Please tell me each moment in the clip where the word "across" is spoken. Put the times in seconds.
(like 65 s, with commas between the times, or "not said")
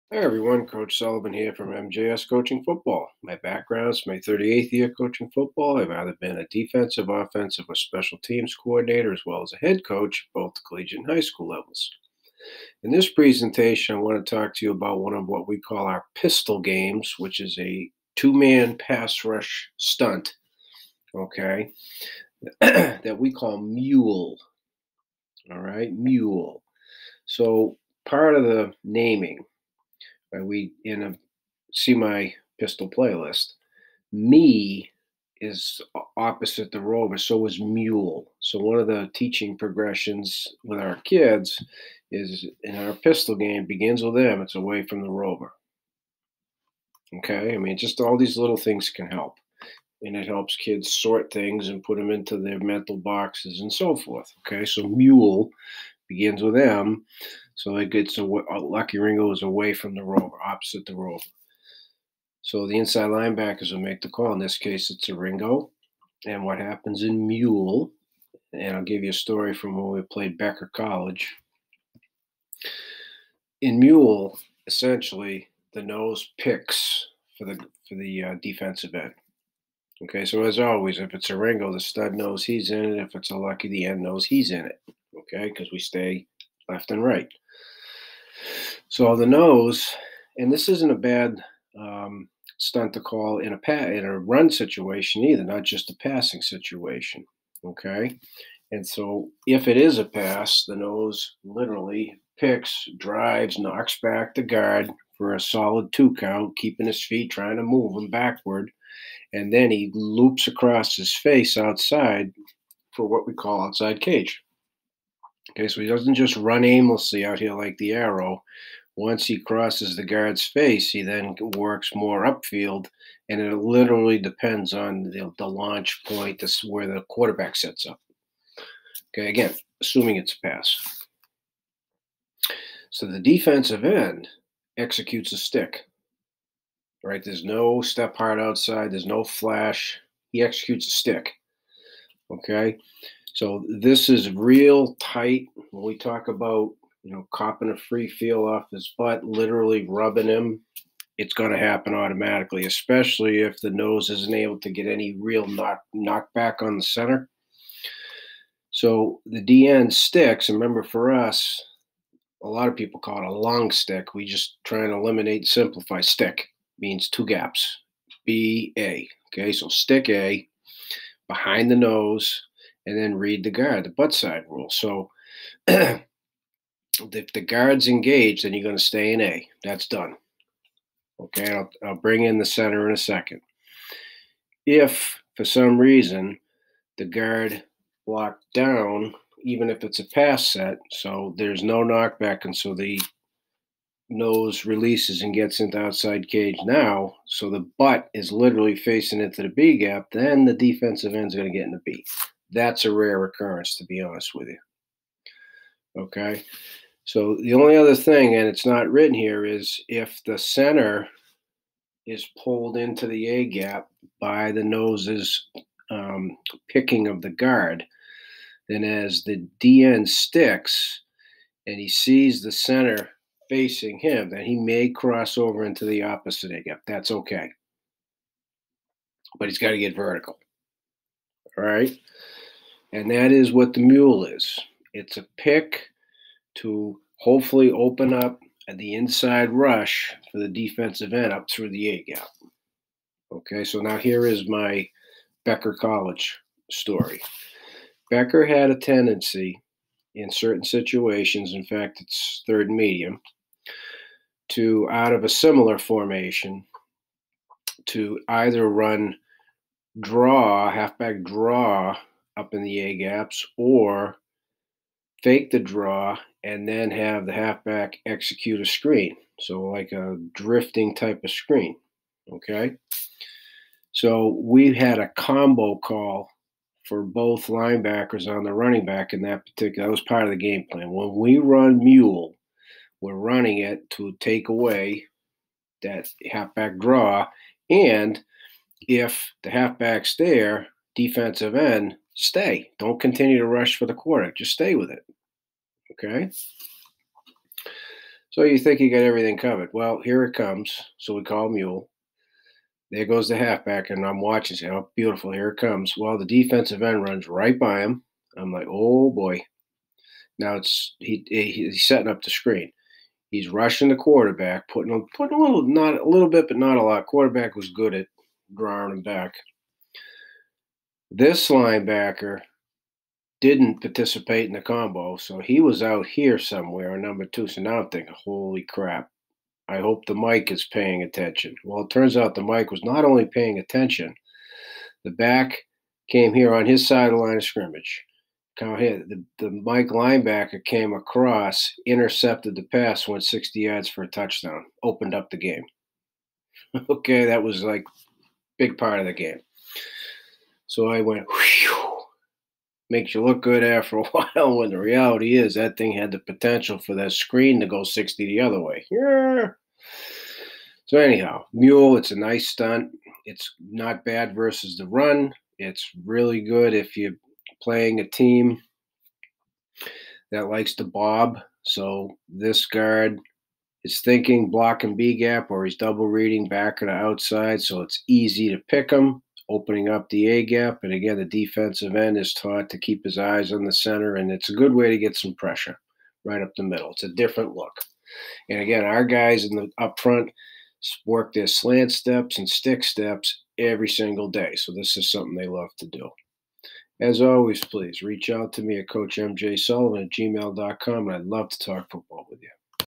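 110 s, 340 s.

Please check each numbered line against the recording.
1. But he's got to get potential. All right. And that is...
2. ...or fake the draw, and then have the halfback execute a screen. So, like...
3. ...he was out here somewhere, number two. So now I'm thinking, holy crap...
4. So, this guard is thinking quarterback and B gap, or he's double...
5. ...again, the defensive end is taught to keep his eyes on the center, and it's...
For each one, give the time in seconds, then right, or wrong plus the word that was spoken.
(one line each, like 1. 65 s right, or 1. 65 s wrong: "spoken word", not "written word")
1. 229 s wrong: "vertical", not "potential"
2. 263 s right
3. 325 s right
4. 371 s wrong: "block", not "quarterback"
5. 380 s right.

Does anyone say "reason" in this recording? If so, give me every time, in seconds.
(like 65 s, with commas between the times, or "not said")
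185 s.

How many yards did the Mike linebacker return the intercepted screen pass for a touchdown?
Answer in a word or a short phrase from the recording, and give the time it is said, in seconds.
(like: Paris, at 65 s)
60, at 343 s.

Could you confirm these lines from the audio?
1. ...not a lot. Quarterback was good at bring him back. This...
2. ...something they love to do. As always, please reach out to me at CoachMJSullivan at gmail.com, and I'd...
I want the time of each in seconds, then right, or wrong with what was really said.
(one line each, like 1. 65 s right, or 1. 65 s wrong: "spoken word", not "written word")
1. 316 s wrong: "drawing", not "bring"
2. 395 s right.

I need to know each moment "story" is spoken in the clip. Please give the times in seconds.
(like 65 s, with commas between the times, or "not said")
69 s, 246 s.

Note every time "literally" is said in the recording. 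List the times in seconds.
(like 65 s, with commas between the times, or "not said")
101 s, 123 s, 149 s, 198 s.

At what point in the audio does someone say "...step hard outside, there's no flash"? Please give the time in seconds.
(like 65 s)
137 s.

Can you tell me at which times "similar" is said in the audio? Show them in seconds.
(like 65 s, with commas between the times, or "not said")
255 s.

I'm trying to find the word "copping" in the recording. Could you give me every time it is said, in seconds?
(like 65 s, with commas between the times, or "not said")
147 s.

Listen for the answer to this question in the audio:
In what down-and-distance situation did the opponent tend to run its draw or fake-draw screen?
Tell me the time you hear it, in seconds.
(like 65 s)
252 s.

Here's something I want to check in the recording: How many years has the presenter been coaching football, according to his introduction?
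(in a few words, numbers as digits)
38.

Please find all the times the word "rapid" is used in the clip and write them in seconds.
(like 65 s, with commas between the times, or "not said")
not said.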